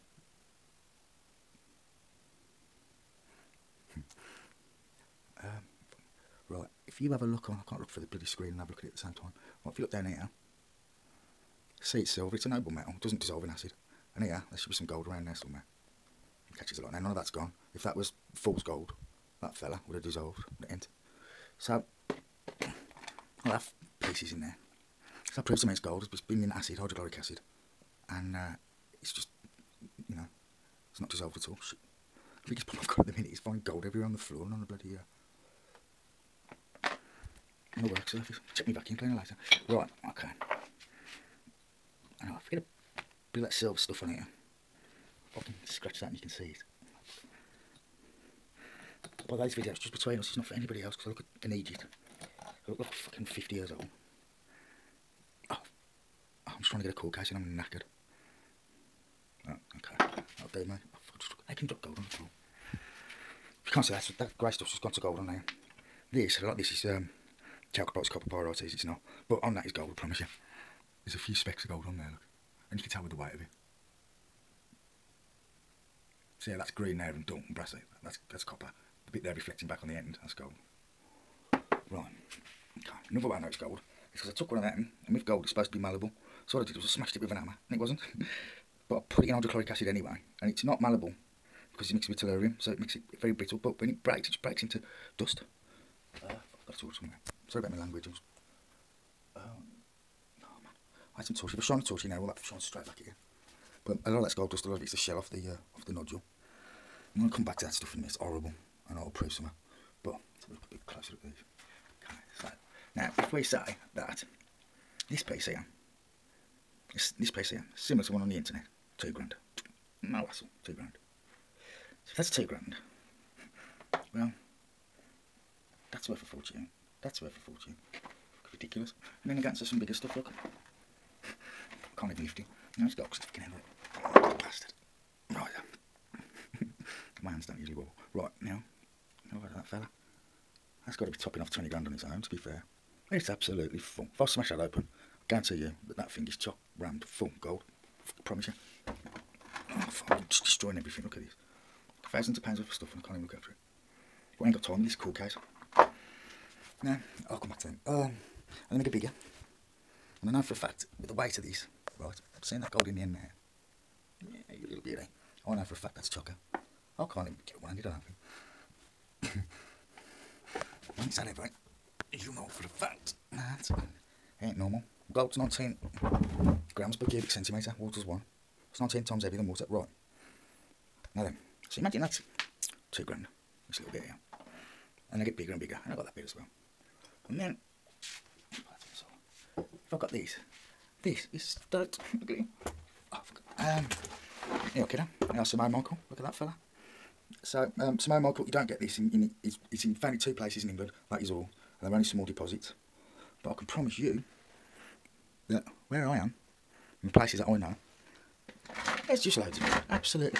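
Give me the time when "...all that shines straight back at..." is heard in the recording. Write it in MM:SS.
01:42.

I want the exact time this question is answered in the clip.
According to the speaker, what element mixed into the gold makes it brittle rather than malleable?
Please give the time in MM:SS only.
01:32.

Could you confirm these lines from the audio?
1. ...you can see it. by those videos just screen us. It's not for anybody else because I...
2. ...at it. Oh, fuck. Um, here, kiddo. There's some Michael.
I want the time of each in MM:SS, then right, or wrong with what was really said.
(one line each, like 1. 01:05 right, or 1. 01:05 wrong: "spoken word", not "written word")
1. 00:46 wrong: "between", not "screen"
2. 03:12 right.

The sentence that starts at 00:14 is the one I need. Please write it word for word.
And here, there should be some gold around there somewhere.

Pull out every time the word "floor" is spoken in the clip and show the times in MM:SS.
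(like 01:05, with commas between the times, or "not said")
00:34, 01:02.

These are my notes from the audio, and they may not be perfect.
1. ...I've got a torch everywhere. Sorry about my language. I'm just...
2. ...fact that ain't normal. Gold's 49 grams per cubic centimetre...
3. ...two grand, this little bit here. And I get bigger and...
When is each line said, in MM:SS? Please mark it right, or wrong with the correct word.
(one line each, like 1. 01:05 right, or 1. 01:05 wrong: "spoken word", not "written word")
1. 01:36 wrong: "somewhere", not "everywhere"
2. 02:52 wrong: "19", not "49"
3. 03:02 right.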